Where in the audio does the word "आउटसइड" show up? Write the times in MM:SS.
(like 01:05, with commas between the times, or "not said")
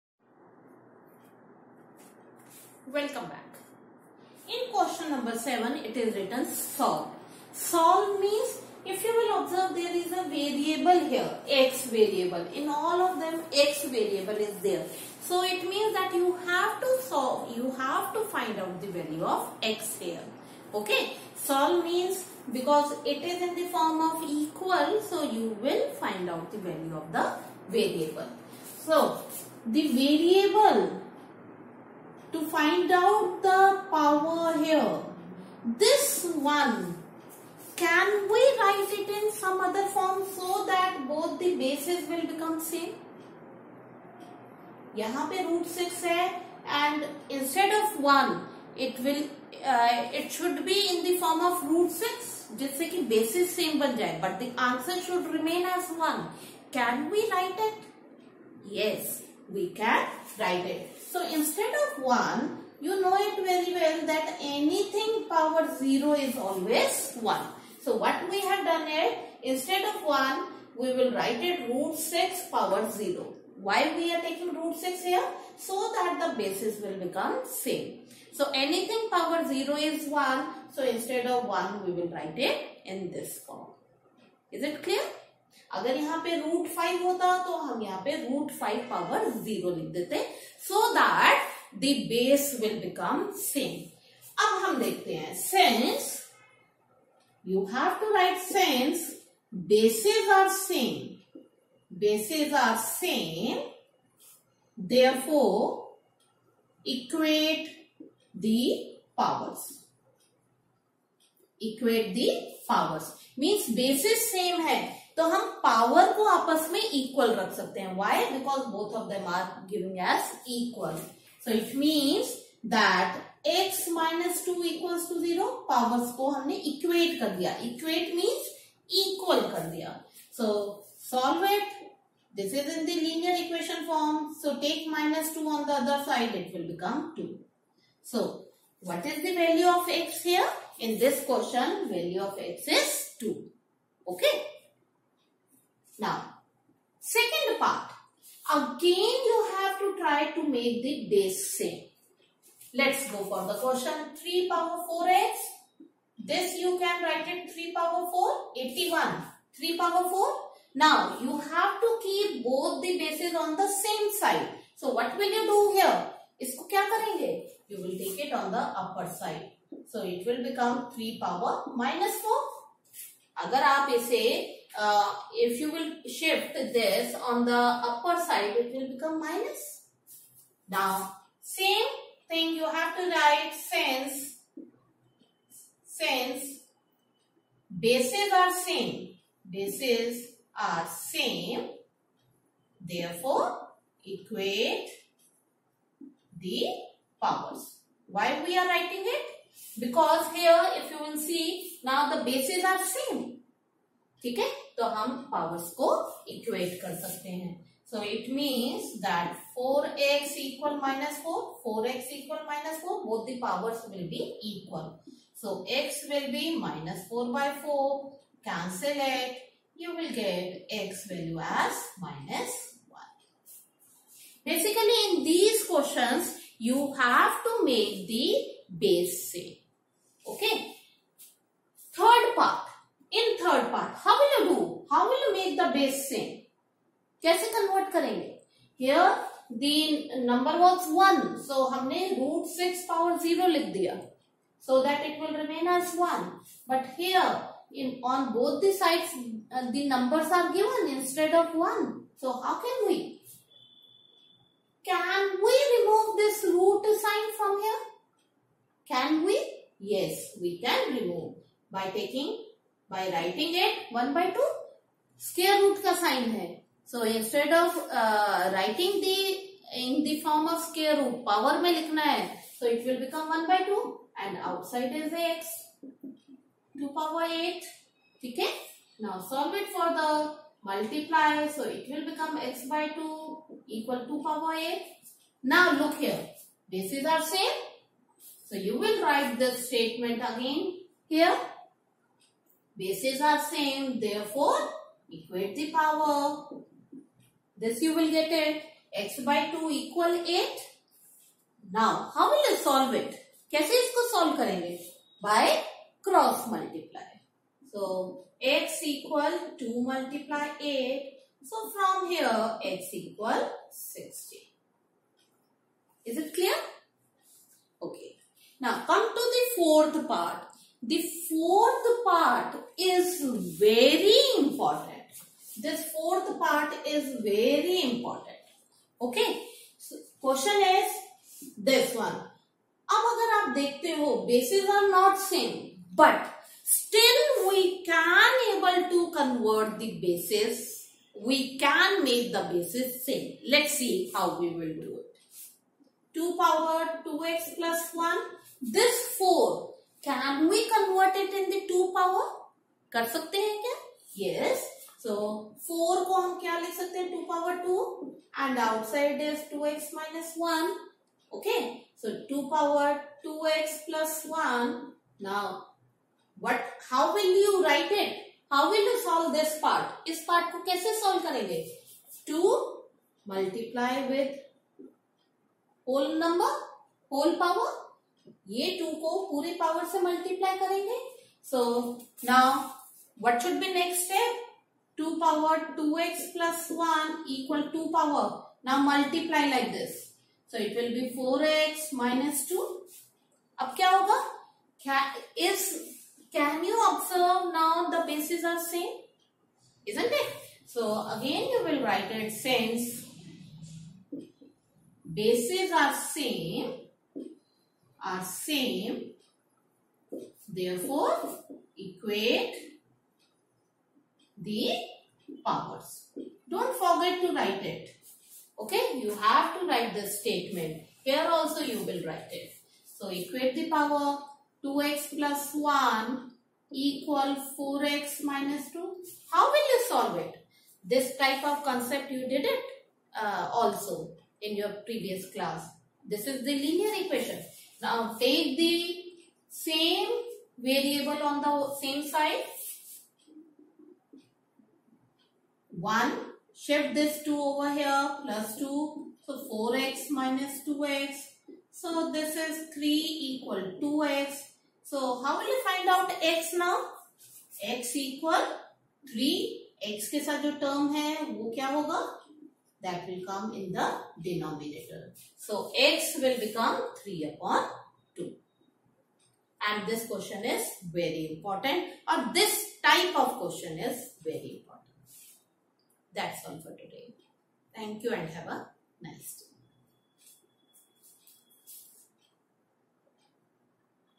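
04:34, 05:58.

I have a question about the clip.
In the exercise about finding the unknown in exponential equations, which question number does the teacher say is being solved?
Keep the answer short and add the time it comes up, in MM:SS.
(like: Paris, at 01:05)
7, at 00:04.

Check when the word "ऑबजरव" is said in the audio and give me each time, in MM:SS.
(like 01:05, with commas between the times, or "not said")
06:36.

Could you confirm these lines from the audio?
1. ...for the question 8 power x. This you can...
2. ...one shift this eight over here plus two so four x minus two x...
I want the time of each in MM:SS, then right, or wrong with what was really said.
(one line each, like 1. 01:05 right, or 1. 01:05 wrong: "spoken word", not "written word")
1. 02:33 wrong: "3", not "8"
2. 07:25 wrong: "two", not "eight".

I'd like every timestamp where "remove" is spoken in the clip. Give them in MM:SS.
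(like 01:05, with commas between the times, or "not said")
04:15, 04:20.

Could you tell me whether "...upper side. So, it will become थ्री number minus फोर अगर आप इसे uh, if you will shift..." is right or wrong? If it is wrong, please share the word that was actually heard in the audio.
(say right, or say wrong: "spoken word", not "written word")
wrong: "power", not "number".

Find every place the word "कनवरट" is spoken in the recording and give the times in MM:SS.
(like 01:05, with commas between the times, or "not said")
05:50.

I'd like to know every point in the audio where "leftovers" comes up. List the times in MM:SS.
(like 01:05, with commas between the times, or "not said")
not said.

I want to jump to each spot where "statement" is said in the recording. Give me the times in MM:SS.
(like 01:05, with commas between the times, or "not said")
04:49, 07:00.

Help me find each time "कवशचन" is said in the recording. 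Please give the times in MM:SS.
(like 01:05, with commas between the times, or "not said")
02:21, 03:45.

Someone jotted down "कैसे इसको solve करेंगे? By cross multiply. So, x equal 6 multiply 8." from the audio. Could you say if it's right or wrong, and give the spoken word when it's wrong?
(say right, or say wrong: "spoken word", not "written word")
wrong: "2", not "6".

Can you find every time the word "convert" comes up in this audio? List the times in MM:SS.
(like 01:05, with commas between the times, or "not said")
03:57, 05:39.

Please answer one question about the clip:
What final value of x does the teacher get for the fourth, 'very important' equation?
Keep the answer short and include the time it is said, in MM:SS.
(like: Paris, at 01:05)
3/2, at 07:47.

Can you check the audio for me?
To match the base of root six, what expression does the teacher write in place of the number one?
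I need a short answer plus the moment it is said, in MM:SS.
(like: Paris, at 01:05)
root 6 power 0, at 01:11.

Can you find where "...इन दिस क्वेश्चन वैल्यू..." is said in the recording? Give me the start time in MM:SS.
02:20.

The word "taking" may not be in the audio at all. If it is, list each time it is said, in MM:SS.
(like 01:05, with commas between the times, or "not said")
01:14, 04:21.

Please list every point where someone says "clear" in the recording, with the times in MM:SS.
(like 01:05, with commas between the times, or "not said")
01:24, 05:16.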